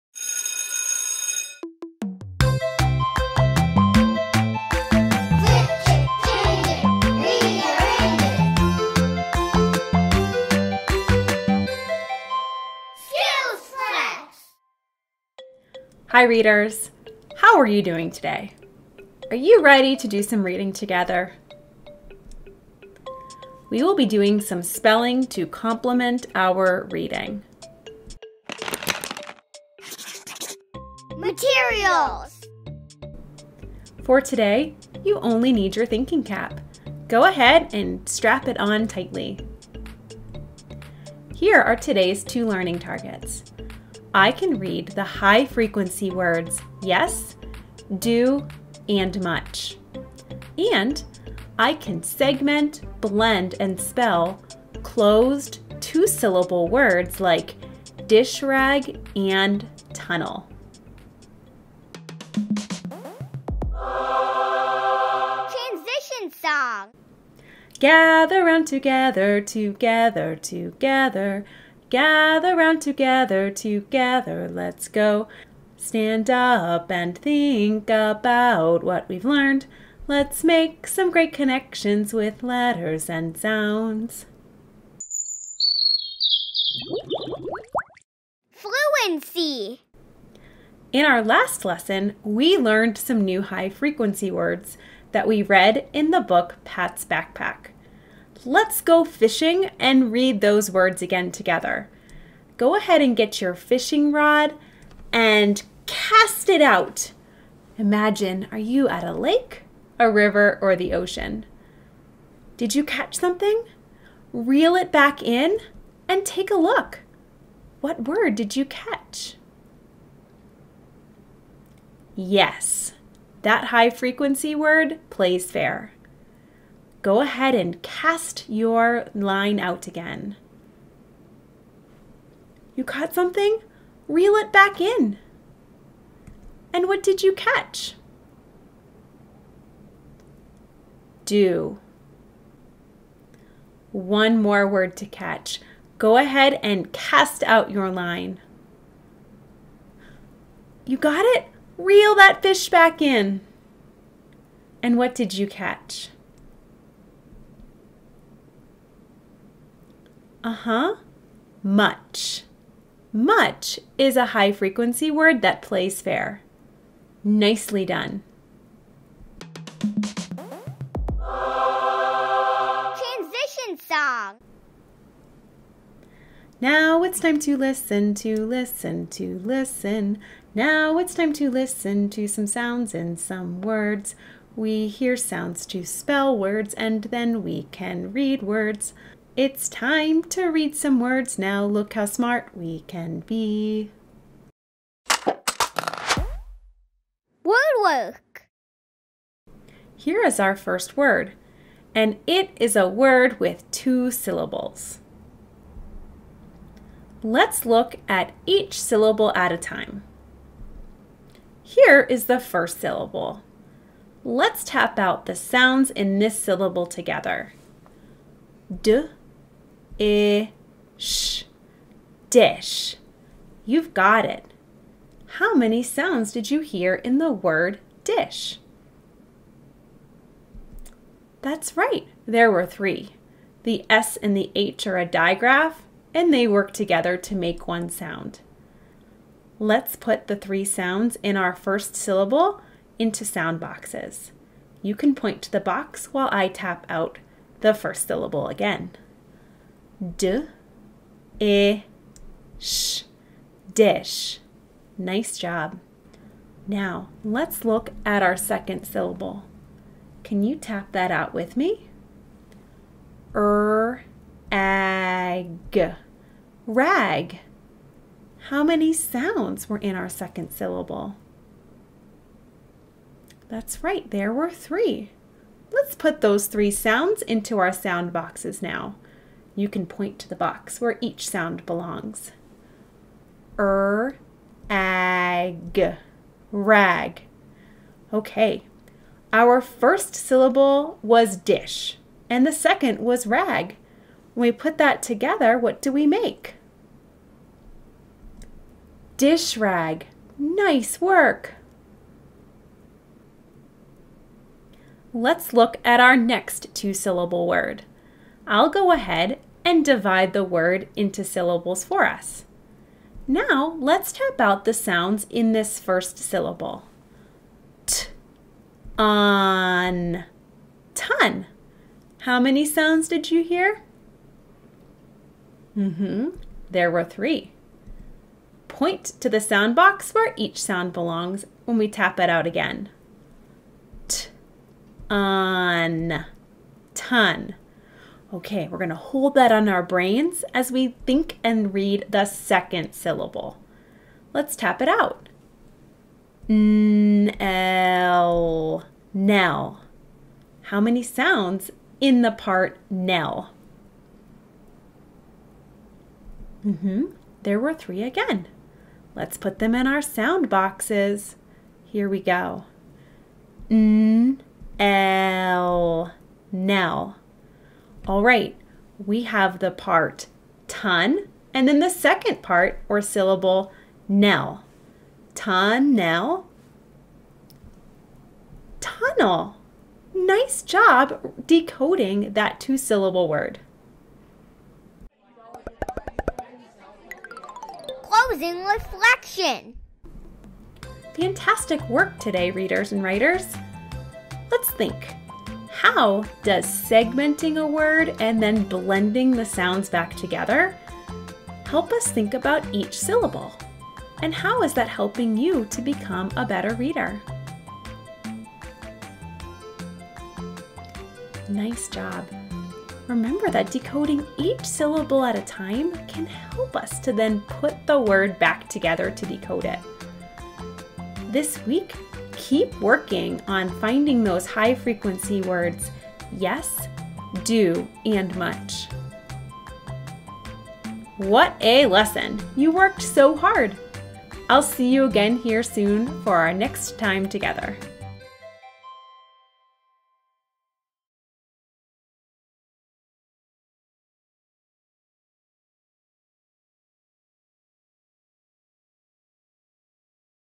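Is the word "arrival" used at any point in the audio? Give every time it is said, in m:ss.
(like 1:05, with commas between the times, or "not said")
not said.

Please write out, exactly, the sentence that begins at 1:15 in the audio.
Stand up and think about what we've learned.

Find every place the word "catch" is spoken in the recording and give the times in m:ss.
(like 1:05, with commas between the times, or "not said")
1:52, 1:58, 2:17, 2:25, 2:35.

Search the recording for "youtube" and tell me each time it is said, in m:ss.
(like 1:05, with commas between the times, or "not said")
not said.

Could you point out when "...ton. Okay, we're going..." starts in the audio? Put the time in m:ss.
5:36.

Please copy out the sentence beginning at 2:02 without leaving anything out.
Yes, that high frequency word plays fair go ahead and cast your line out again.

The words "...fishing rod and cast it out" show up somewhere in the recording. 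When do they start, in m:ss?
1:43.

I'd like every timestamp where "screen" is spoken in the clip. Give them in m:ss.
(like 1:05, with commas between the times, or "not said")
not said.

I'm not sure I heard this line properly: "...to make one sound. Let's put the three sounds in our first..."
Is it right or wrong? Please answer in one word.
right.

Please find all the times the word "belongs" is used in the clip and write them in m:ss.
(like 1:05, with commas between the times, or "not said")
4:41, 5:30.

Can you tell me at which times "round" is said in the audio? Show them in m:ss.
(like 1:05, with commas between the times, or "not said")
1:08, 1:12.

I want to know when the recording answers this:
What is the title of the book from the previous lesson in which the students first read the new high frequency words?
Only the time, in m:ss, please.
1:36.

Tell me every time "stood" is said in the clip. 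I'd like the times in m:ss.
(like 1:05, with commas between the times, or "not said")
not said.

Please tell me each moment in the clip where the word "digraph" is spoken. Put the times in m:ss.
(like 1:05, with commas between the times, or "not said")
3:55.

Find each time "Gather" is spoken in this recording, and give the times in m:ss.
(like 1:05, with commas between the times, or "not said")
1:07, 1:11.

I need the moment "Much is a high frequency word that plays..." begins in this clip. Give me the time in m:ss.
2:43.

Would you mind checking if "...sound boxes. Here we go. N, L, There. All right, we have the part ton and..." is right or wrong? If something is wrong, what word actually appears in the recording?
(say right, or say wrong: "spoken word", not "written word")
wrong: "Nell", not "There".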